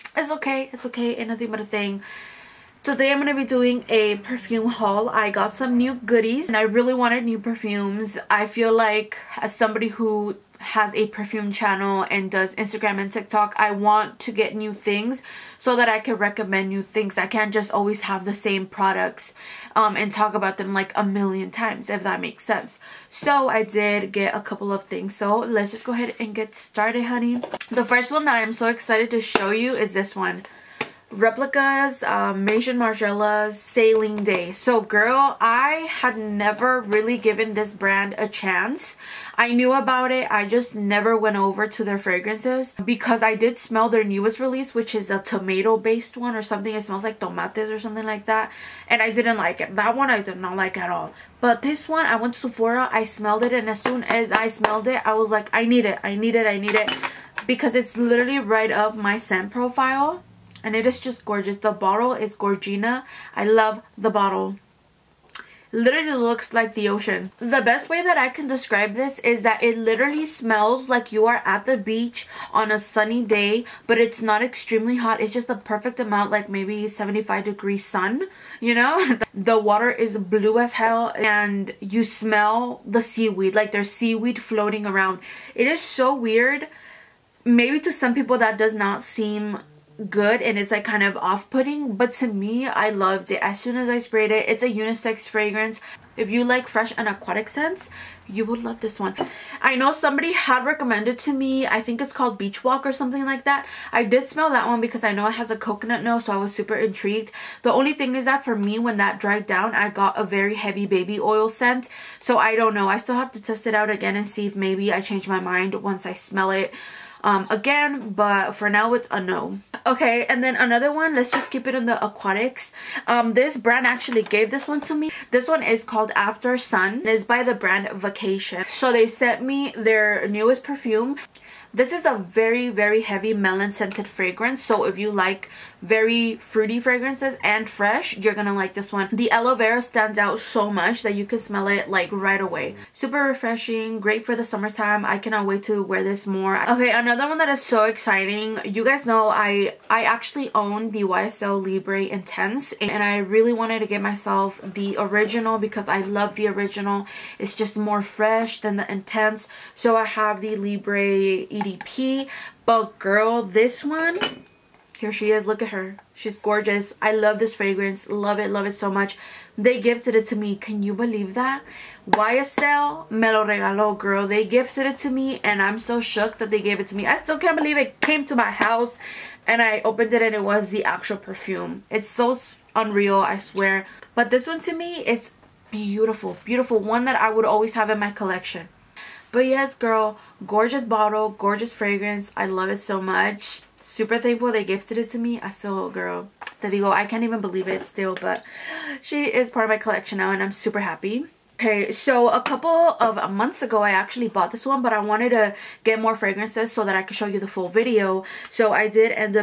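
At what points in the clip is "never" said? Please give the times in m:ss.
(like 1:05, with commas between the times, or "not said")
0:36, 0:40.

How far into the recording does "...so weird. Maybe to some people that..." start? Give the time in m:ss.
1:25.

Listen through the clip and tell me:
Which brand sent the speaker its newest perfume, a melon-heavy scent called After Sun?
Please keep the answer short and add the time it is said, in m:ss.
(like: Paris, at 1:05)
Vacation, at 2:07.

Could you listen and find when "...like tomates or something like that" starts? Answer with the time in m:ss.
0:47.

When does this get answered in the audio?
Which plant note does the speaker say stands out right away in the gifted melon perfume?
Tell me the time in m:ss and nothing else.
2:19.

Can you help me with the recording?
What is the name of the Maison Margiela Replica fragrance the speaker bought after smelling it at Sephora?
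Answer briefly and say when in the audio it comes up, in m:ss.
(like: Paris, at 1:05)
Sailing Day, at 0:33.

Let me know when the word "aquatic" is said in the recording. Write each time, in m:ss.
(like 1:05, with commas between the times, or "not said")
1:37, 2:02.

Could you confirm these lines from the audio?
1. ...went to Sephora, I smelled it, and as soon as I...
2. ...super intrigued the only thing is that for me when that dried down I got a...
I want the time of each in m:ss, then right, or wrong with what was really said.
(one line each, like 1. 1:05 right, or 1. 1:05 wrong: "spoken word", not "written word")
1. 0:52 right
2. 1:46 right.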